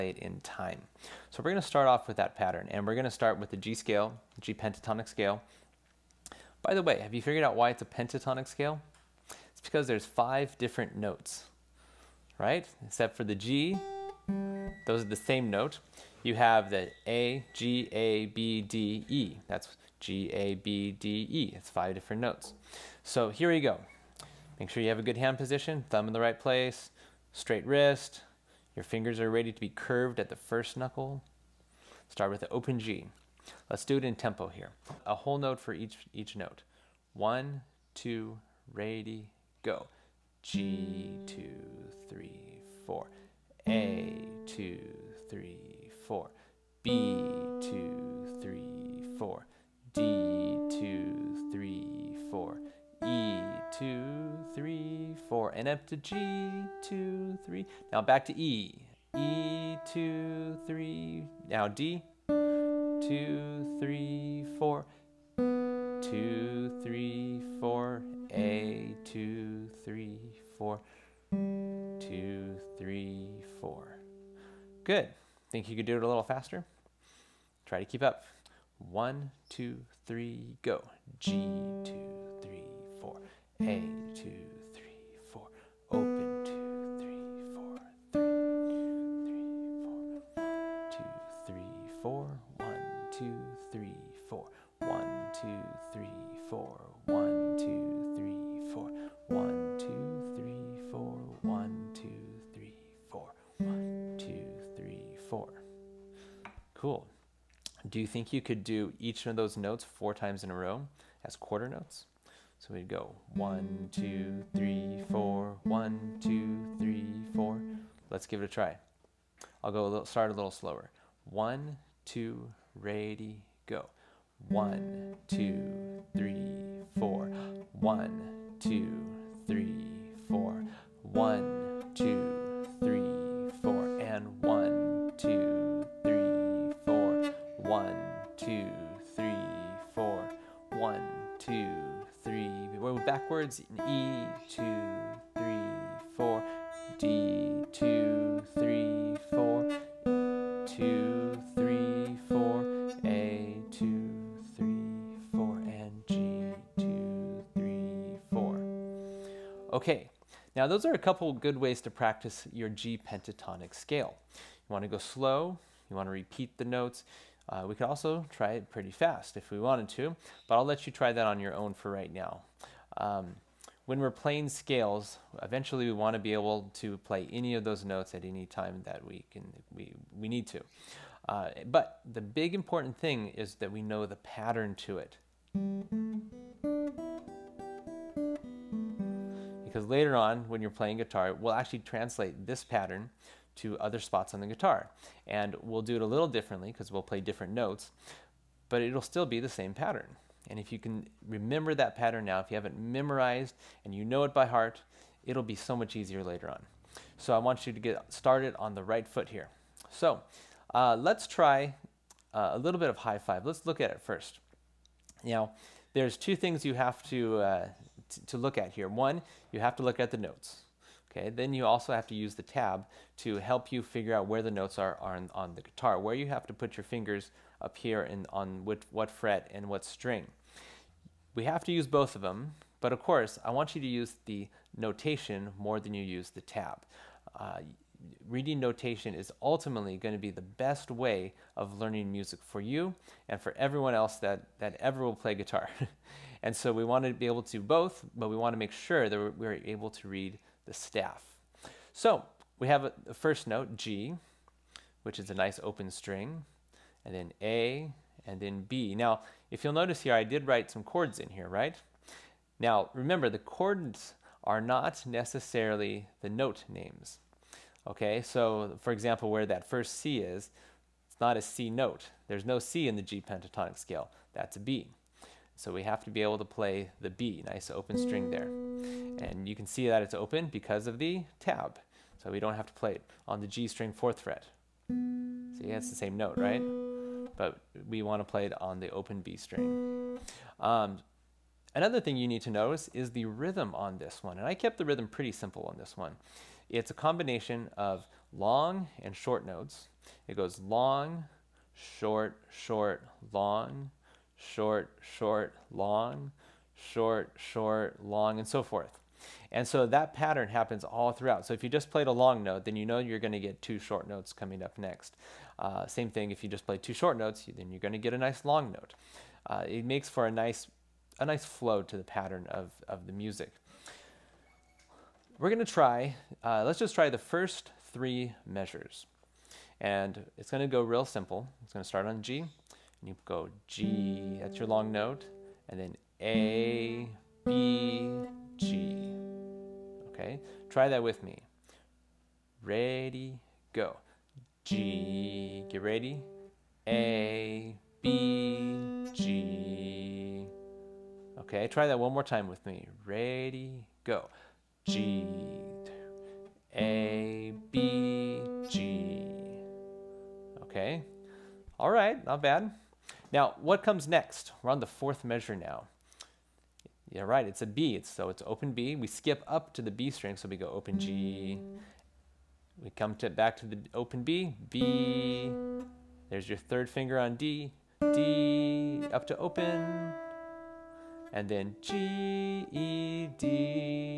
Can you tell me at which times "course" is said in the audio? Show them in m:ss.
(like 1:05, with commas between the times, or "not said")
3:53.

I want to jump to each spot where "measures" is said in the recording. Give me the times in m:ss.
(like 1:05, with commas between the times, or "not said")
5:28, 6:05.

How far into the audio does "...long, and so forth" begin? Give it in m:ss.
5:08.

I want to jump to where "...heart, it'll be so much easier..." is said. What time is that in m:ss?
3:24.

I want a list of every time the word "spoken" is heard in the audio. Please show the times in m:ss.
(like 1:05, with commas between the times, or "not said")
not said.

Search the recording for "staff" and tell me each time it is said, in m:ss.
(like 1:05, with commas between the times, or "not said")
4:10.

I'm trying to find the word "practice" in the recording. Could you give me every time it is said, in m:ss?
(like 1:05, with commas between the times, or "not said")
2:41.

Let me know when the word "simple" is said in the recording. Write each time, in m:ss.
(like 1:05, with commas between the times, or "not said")
4:55, 5:31.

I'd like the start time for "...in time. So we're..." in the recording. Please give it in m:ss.
0:00.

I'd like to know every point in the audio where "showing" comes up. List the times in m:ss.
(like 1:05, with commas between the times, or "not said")
not said.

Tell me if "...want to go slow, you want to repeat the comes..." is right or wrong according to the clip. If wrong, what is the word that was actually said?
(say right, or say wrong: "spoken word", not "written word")
wrong: "notes", not "comes".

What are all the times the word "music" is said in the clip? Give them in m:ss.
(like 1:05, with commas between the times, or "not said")
4:02, 5:23.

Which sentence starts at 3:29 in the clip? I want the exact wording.
So uh, let's try uh, a little bit of high five.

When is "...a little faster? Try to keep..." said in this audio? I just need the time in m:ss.
1:16.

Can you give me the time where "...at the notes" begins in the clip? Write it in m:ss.
3:39.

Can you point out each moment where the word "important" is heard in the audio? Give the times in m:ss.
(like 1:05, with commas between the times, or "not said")
3:02.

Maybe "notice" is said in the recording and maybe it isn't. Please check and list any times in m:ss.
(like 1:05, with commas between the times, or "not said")
4:19, 4:52.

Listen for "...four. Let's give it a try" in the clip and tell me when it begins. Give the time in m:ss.
1:57.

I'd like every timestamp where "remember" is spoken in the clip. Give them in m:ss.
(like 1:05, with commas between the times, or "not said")
3:21, 4:22.